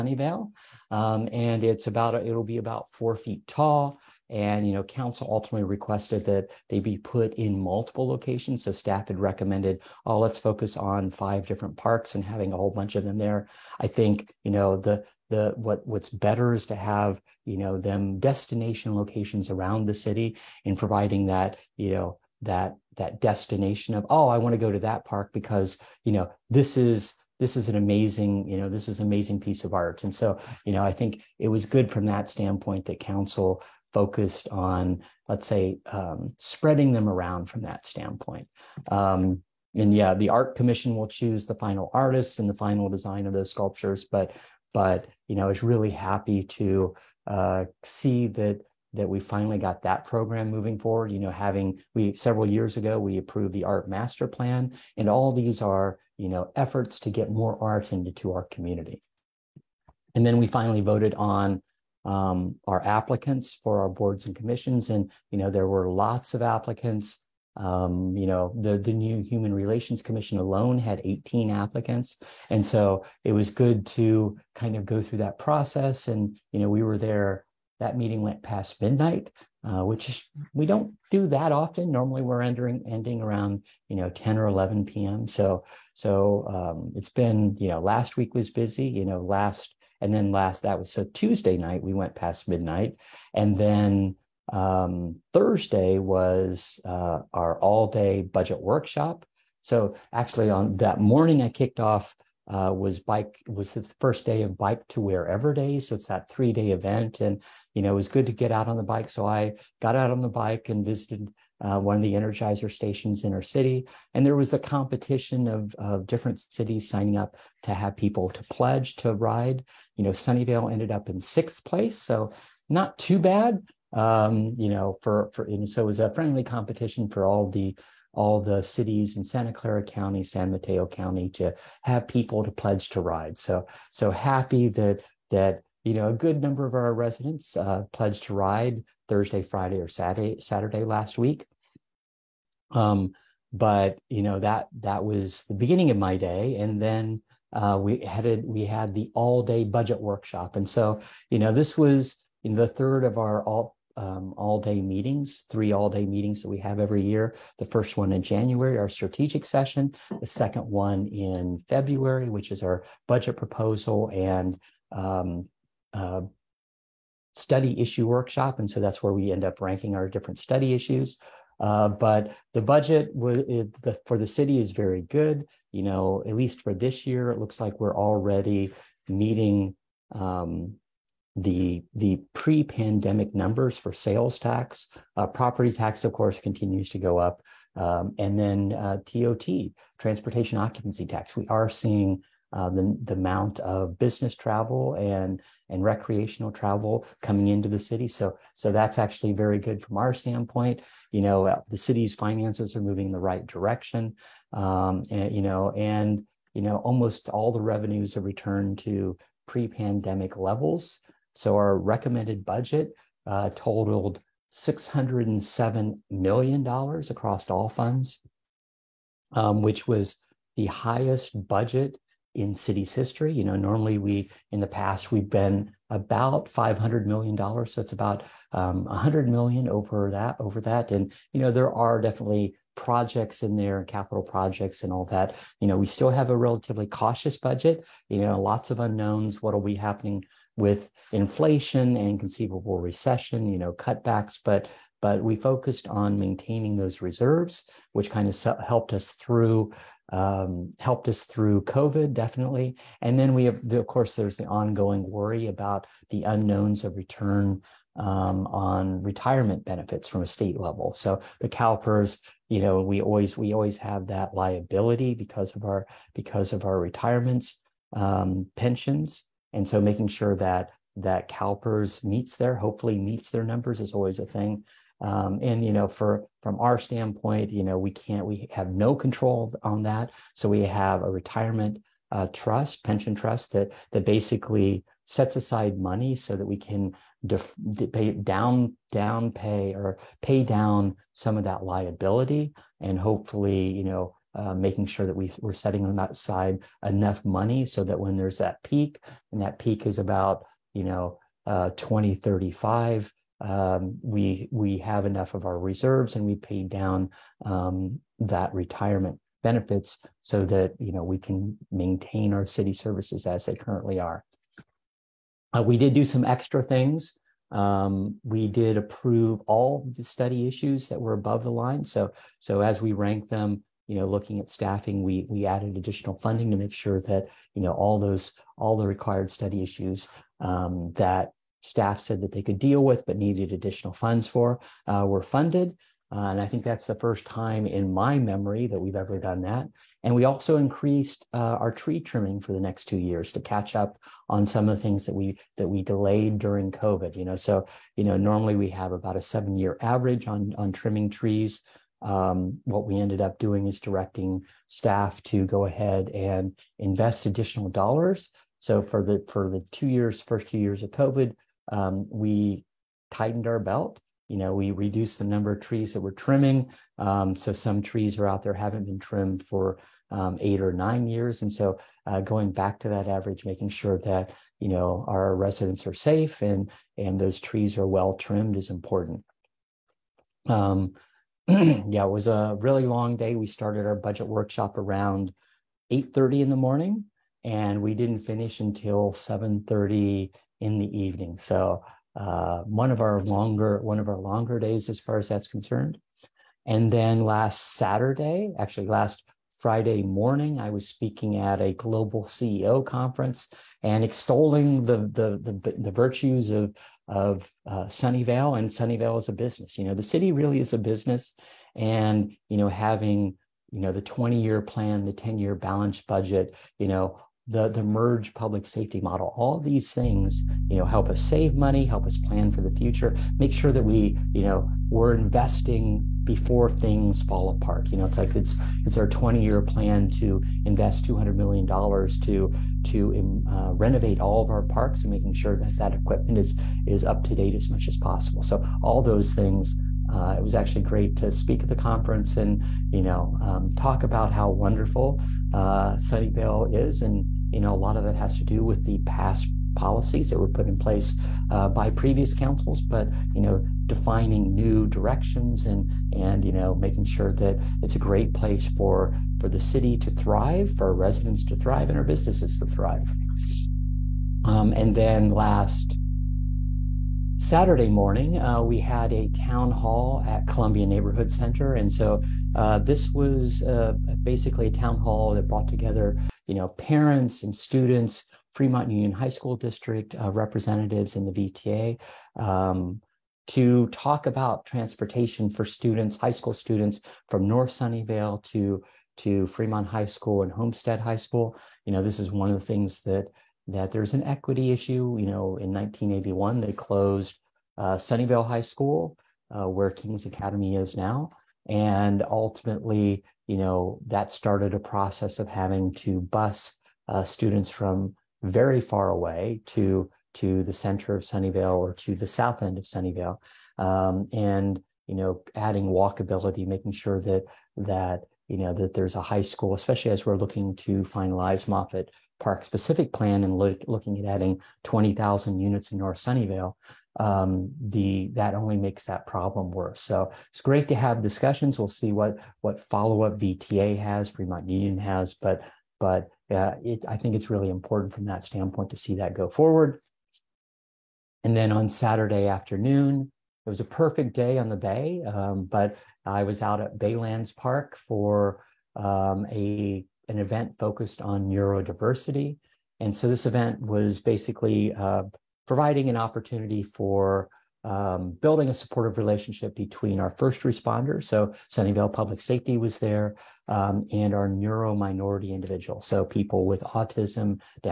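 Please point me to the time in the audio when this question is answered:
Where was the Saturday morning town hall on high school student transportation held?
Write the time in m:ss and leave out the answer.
7:50.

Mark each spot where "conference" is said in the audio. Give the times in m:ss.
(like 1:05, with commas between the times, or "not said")
6:42, 7:21.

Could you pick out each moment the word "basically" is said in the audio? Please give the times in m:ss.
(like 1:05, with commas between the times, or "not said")
4:44, 7:54, 9:14.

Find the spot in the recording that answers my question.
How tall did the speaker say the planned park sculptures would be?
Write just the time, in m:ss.
0:02.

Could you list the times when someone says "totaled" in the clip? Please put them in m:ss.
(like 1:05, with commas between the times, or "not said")
3:33.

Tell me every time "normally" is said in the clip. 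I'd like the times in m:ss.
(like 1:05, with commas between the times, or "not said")
1:21, 3:43, 5:48.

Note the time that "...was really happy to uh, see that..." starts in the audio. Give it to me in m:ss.
0:45.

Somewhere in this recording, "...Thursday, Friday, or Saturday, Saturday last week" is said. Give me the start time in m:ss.
2:19.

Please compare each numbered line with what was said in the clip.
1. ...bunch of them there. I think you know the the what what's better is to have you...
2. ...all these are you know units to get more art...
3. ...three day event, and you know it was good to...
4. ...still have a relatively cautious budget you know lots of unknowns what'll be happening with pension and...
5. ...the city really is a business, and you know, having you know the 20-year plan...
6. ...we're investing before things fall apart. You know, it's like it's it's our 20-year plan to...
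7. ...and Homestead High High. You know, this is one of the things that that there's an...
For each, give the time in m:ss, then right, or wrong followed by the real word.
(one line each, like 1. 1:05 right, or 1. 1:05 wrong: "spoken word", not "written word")
1. 0:12 right
2. 0:55 wrong: "efforts", not "units"
3. 1:46 right
4. 3:55 wrong: "inflation", not "pension"
5. 6:49 right
6. 7:04 right
7. 8:10 wrong: "School", not "High".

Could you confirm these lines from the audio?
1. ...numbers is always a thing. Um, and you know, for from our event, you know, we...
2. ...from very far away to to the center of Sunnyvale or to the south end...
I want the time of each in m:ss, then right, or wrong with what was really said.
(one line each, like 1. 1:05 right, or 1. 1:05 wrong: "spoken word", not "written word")
1. 4:33 wrong: "standpoint", not "event"
2. 8:27 right.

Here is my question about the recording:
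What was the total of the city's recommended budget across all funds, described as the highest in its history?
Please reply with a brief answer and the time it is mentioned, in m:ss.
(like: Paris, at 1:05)
$607 million, at 3:34.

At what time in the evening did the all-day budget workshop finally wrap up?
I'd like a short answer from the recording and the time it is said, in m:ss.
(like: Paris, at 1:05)
7:30, at 6:29.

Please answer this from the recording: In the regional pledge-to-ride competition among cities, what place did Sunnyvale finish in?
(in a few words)
Sixth.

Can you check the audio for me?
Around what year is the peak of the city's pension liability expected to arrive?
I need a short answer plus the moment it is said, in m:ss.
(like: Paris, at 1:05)
2035, at 5:01.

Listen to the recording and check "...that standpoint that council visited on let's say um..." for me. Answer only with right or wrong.
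wrong.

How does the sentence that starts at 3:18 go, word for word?
So so that's actually very good from our standpoint.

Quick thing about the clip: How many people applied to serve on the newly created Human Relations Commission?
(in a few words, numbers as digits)
18.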